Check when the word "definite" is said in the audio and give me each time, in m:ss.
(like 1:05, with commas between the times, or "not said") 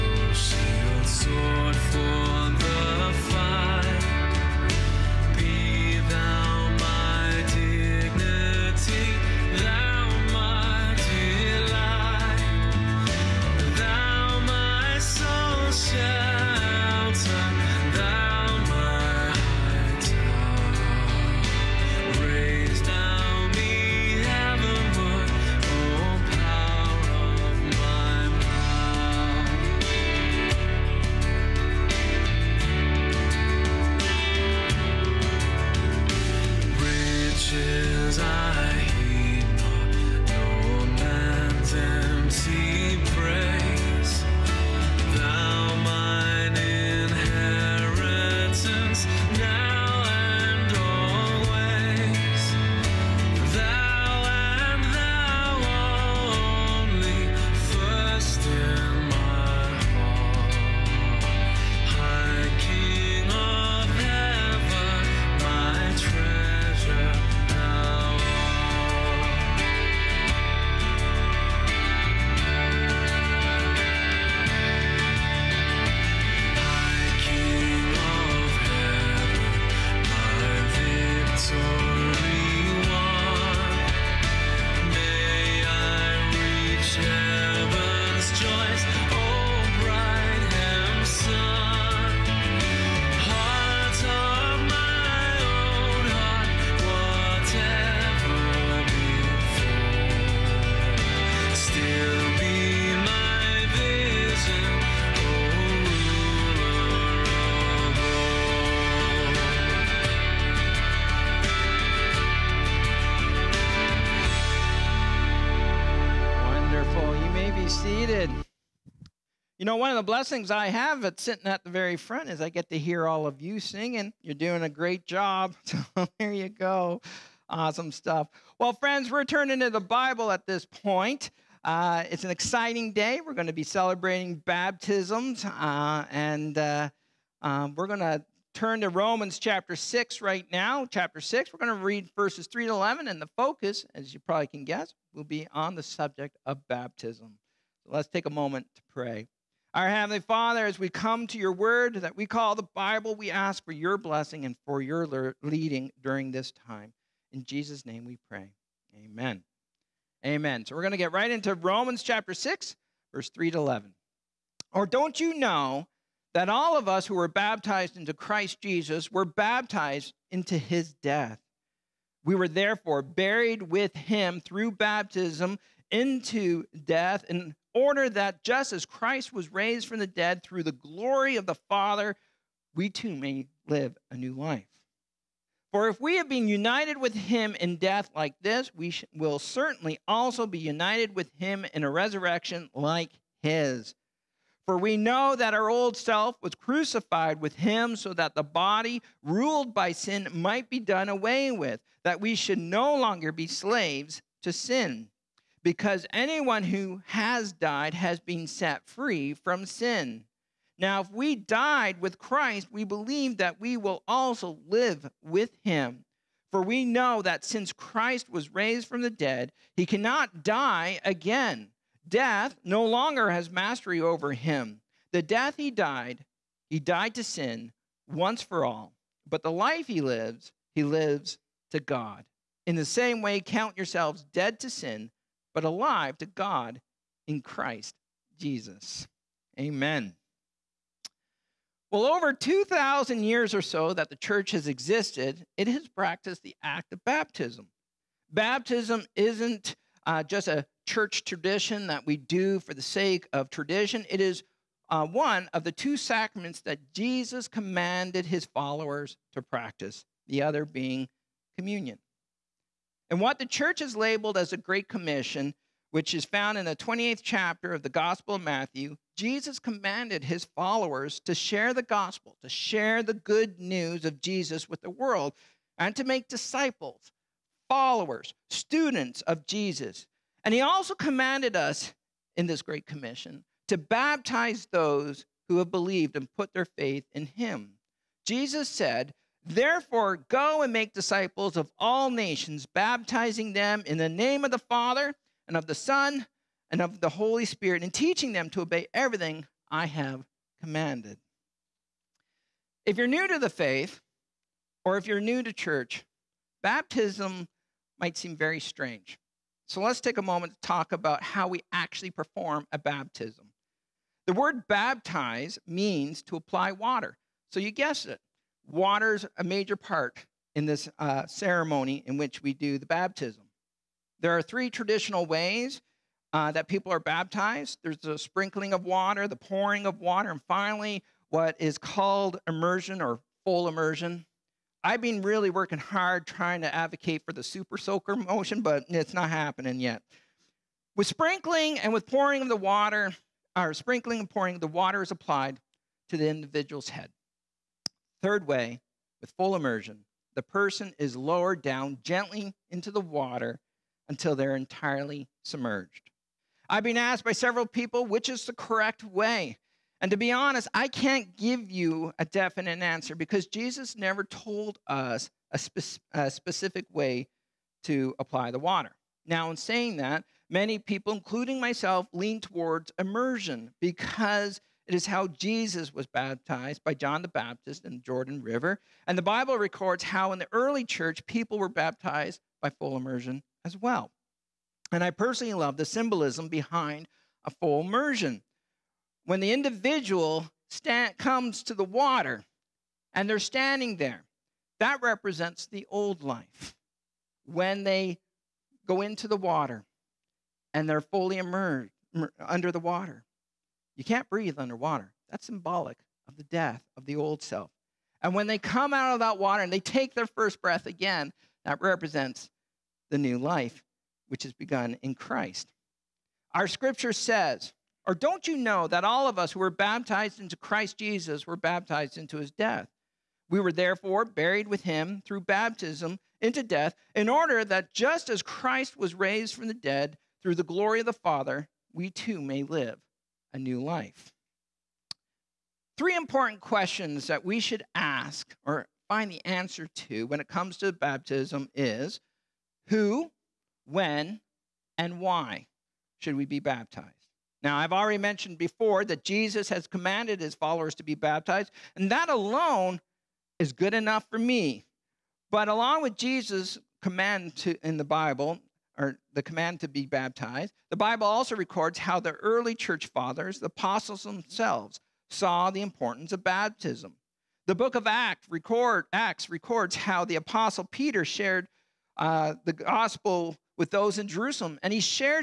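6:02.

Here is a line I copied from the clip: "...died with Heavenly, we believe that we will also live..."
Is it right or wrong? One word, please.
wrong.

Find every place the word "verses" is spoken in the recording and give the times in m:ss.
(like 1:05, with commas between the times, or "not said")
2:22, 2:43.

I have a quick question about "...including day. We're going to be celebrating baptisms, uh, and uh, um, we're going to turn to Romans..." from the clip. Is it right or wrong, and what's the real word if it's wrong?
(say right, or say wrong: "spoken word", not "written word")
wrong: "exciting", not "including".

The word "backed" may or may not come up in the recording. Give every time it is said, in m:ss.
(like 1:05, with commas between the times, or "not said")
not said.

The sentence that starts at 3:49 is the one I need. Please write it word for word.
But the life he lives, he lives to God.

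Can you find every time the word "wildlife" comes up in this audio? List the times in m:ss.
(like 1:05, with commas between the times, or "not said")
not said.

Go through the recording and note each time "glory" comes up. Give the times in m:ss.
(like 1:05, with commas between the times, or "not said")
3:00, 7:10.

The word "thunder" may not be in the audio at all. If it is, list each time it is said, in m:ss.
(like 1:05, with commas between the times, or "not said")
not said.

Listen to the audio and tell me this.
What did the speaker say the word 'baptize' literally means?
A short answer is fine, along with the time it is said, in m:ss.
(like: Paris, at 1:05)
To apply water, at 5:16.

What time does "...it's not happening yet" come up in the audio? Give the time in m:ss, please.
5:38.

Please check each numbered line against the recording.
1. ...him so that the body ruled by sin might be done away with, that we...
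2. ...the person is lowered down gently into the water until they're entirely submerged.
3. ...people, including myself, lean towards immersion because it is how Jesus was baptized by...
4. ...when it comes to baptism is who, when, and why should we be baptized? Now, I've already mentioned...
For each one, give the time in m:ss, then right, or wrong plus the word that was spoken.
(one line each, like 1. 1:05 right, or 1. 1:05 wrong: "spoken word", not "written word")
1. 3:17 right
2. 5:50 right
3. 6:10 right
4. 7:20 right.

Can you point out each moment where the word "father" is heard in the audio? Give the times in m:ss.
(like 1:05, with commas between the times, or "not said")
2:30, 3:01, 4:54, 7:11, 7:43.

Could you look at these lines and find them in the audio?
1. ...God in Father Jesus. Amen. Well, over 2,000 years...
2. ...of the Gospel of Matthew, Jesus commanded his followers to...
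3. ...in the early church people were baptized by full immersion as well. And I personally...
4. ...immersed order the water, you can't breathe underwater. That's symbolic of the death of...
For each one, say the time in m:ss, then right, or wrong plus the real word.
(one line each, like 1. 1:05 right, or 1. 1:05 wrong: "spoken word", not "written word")
1. 3:56 wrong: "Christ", not "Father"
2. 4:27 right
3. 6:20 right
4. 6:41 wrong: "under", not "order".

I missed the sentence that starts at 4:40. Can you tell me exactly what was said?
And he also commanded us in this Great Commission to baptize those who have believed and put their faith in him.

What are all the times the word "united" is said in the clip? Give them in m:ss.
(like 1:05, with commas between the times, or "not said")
3:06, 3:10.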